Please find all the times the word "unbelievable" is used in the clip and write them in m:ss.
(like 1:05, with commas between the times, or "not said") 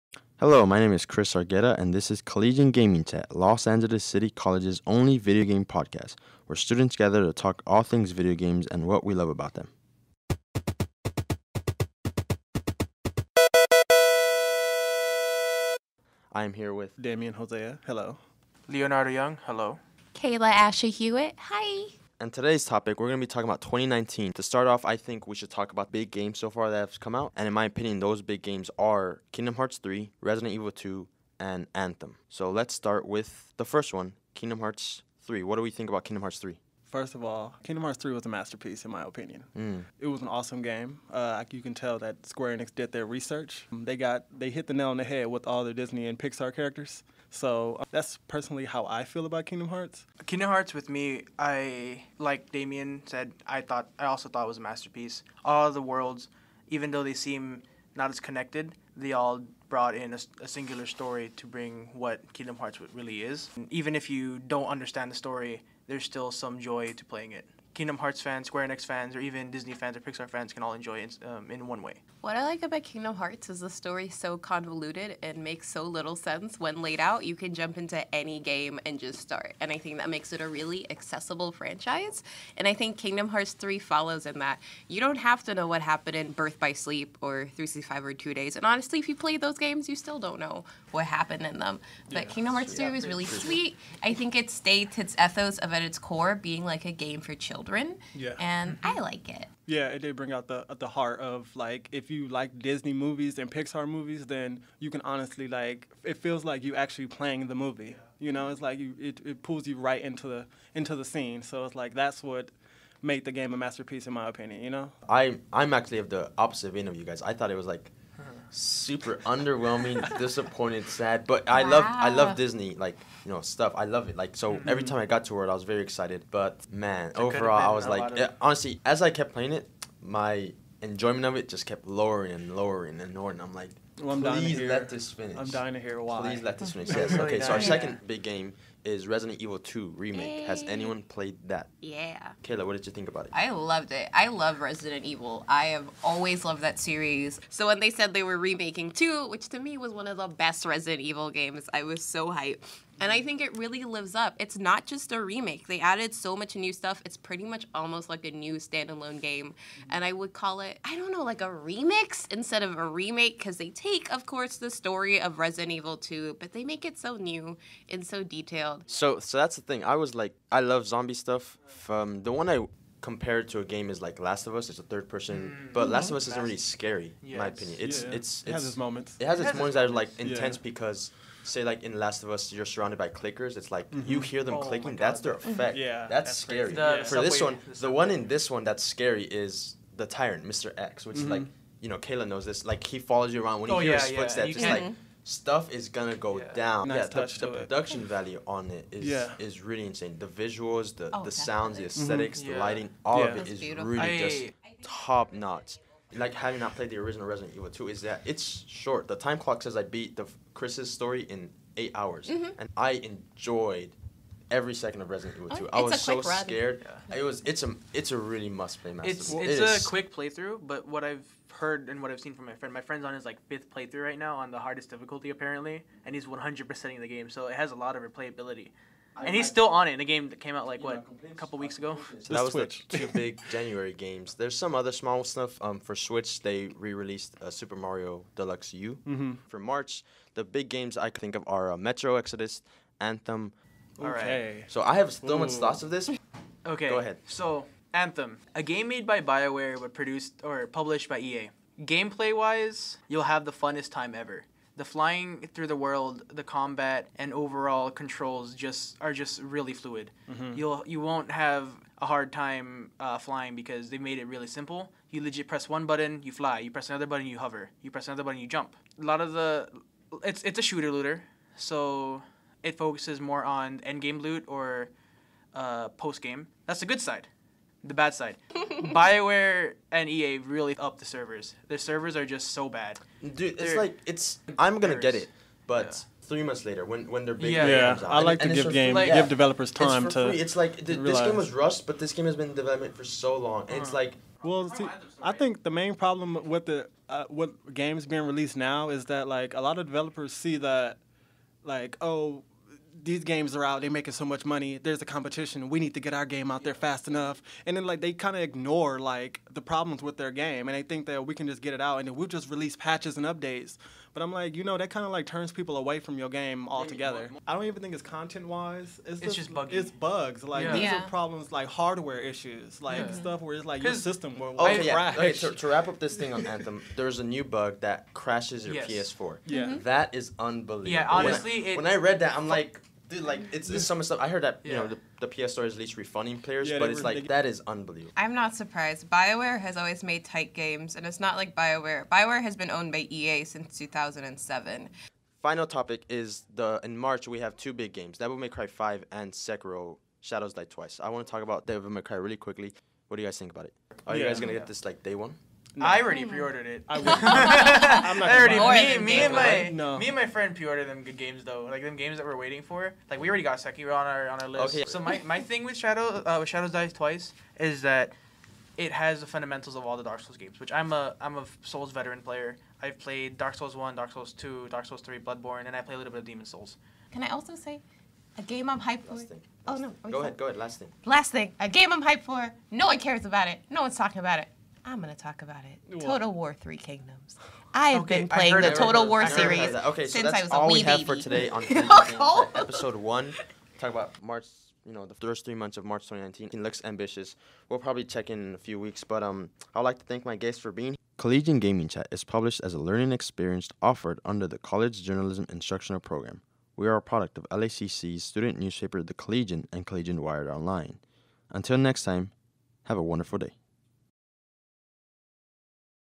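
5:30, 5:37.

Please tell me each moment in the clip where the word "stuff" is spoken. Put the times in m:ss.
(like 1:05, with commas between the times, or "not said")
2:03, 2:36, 2:51, 3:15, 3:55, 5:23, 5:34.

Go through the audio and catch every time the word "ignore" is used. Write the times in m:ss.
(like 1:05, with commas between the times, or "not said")
5:08.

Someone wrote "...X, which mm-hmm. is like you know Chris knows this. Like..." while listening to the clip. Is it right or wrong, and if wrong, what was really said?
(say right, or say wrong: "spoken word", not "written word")
wrong: "Kayla", not "Chris".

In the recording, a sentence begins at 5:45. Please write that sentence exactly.
Final topic is the in March we have two big games: Devil May Cry 5 and Sekiro Shadows Die Twice.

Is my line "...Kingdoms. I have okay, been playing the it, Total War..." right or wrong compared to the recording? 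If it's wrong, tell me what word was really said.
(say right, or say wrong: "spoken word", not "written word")
right.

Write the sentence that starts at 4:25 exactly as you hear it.
You legit press one button, you fly.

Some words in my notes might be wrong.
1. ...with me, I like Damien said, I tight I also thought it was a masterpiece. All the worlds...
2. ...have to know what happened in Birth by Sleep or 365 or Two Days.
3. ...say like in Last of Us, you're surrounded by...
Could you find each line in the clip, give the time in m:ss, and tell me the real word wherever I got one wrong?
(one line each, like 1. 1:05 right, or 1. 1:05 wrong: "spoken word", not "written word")
1. 0:50 wrong: "thought", not "tight"
2. 1:25 right
3. 3:01 right.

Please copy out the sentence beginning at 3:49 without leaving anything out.
I, and he's I, still on it in a game that came out like what know, a couple weeks ago.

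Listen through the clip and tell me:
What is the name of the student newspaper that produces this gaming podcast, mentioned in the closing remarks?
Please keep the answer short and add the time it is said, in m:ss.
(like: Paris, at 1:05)
The Collegian, at 6:49.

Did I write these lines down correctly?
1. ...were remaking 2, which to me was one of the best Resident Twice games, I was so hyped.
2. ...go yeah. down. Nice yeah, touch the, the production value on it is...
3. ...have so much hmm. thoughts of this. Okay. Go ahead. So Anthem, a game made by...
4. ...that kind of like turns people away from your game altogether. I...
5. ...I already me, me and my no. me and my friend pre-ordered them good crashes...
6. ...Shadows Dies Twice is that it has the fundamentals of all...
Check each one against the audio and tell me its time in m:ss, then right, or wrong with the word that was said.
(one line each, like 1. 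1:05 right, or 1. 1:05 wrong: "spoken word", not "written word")
1. 2:28 wrong: "Evil", not "Twice"
2. 3:16 right
3. 4:04 right
4. 5:14 right
5. 5:58 wrong: "games", not "crashes"
6. 6:06 right.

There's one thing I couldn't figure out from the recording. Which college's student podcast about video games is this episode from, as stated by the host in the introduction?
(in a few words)
Los Angeles City College.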